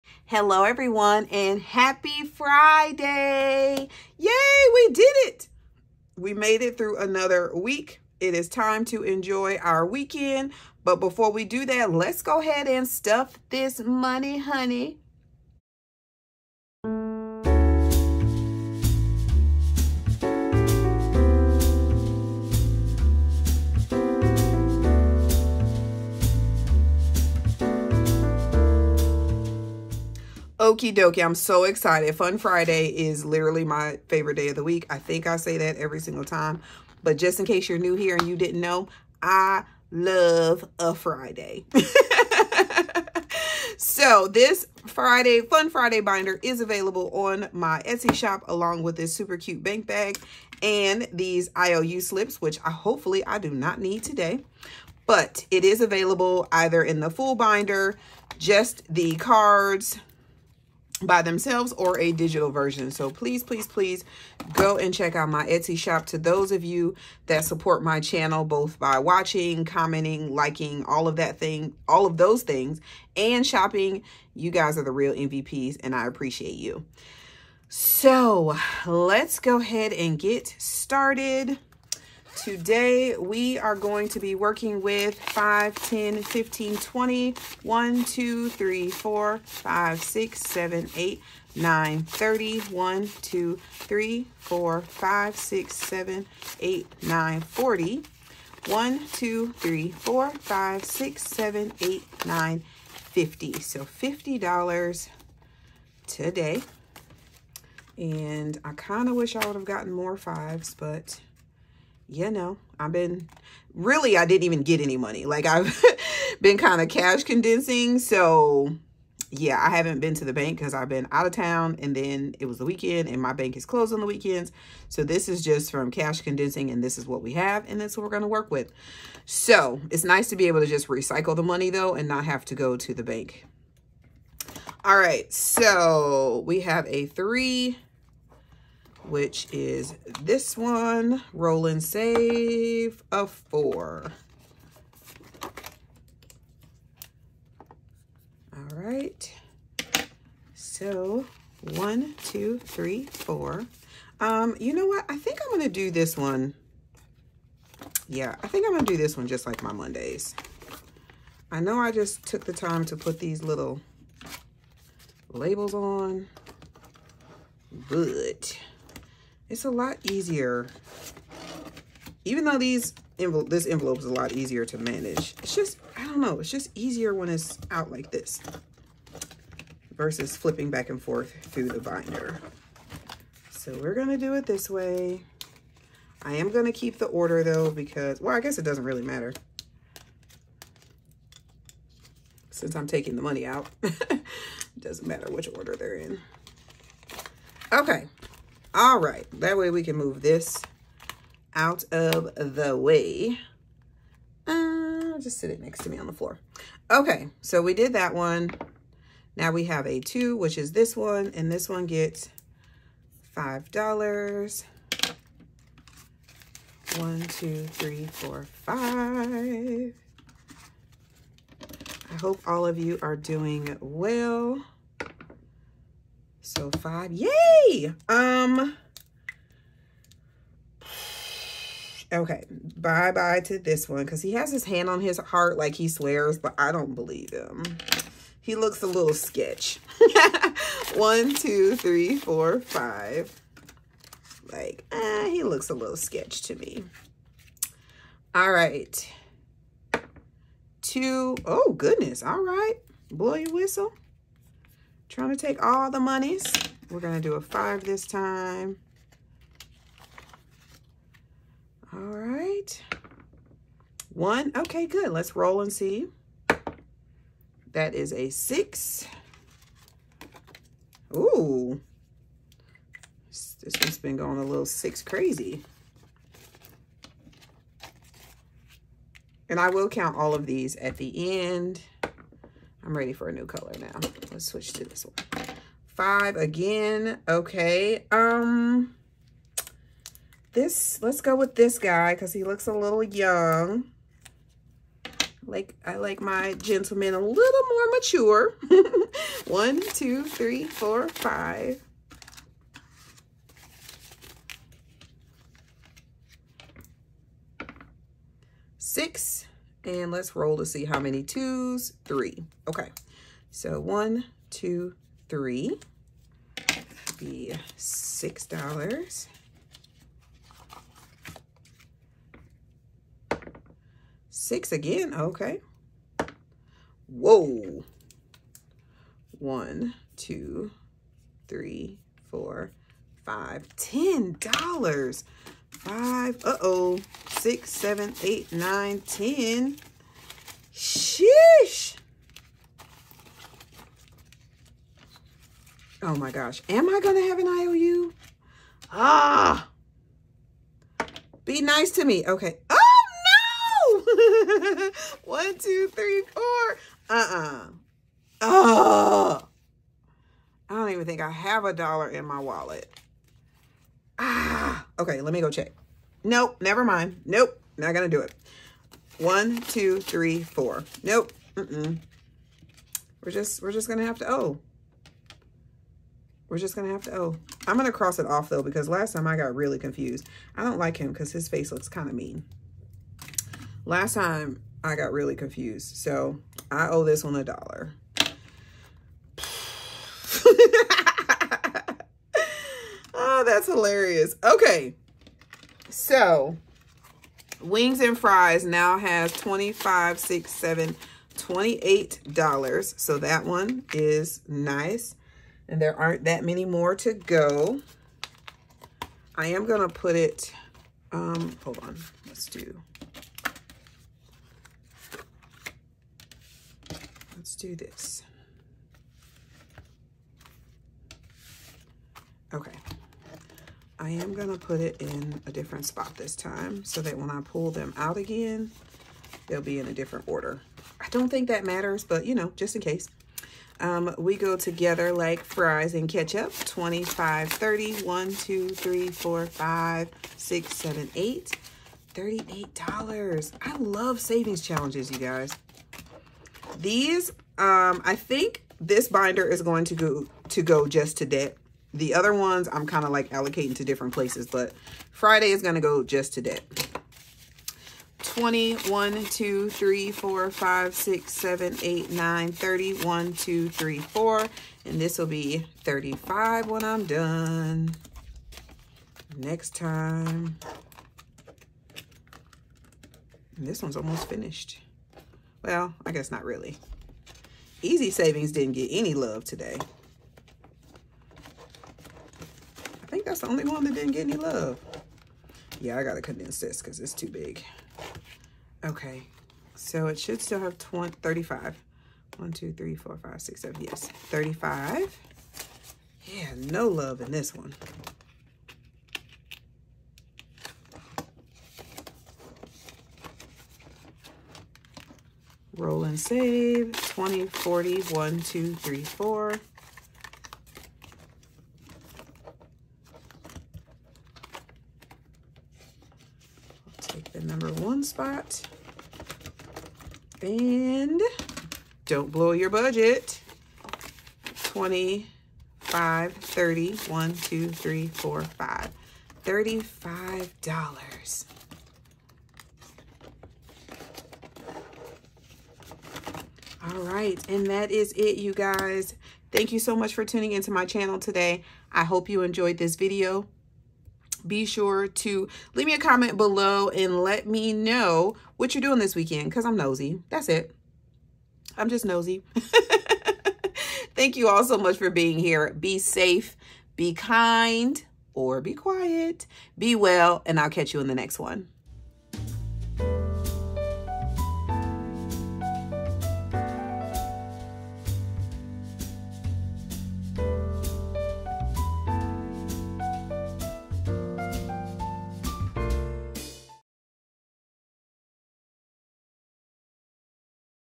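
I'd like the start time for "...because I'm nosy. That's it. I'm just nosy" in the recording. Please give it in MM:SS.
09:09.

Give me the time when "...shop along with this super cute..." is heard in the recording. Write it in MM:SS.
00:48.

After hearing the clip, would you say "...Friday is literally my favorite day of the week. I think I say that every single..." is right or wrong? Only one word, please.
right.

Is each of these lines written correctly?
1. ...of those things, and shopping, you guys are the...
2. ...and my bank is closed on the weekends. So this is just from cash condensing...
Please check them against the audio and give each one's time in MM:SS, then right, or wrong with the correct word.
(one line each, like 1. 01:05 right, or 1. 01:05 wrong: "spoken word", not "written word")
1. 01:12 right
2. 02:03 right.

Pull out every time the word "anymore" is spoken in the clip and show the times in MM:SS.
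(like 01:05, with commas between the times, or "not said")
not said.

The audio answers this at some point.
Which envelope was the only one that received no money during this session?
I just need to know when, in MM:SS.
07:57.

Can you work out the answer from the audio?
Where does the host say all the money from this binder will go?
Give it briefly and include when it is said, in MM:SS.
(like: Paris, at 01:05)
Debt, at 07:31.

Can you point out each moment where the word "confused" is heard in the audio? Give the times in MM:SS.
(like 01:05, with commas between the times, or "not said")
06:19, 06:25.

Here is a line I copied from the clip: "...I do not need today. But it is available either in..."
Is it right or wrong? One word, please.
right.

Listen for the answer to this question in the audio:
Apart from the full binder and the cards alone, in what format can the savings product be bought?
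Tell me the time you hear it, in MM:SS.
01:02.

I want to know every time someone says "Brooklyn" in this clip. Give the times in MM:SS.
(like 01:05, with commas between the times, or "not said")
not said.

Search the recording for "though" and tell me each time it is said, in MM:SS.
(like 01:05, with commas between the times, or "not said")
02:11, 02:52, 03:07, 06:18.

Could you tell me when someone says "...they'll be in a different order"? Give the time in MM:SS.
07:09.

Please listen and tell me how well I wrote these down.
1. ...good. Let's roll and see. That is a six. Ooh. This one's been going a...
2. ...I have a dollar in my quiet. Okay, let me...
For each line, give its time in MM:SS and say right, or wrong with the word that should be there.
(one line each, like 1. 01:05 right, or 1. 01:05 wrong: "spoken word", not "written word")
1. 04:24 right
2. 06:01 wrong: "wallet", not "quiet".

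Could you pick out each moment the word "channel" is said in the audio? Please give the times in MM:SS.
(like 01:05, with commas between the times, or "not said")
01:07, 09:00.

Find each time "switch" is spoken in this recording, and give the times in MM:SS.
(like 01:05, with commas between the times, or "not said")
04:44.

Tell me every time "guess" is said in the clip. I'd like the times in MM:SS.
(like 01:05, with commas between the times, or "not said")
03:08, 07:56.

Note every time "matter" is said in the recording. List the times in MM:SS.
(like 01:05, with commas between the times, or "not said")
03:09, 03:15, 07:11.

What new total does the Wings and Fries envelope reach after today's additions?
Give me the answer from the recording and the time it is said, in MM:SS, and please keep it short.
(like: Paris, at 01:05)
$28, at 06:41.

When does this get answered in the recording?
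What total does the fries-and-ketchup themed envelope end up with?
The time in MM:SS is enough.
07:22.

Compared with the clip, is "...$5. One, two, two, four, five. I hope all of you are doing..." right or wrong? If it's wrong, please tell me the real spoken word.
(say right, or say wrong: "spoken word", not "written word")
wrong: "three", not "two".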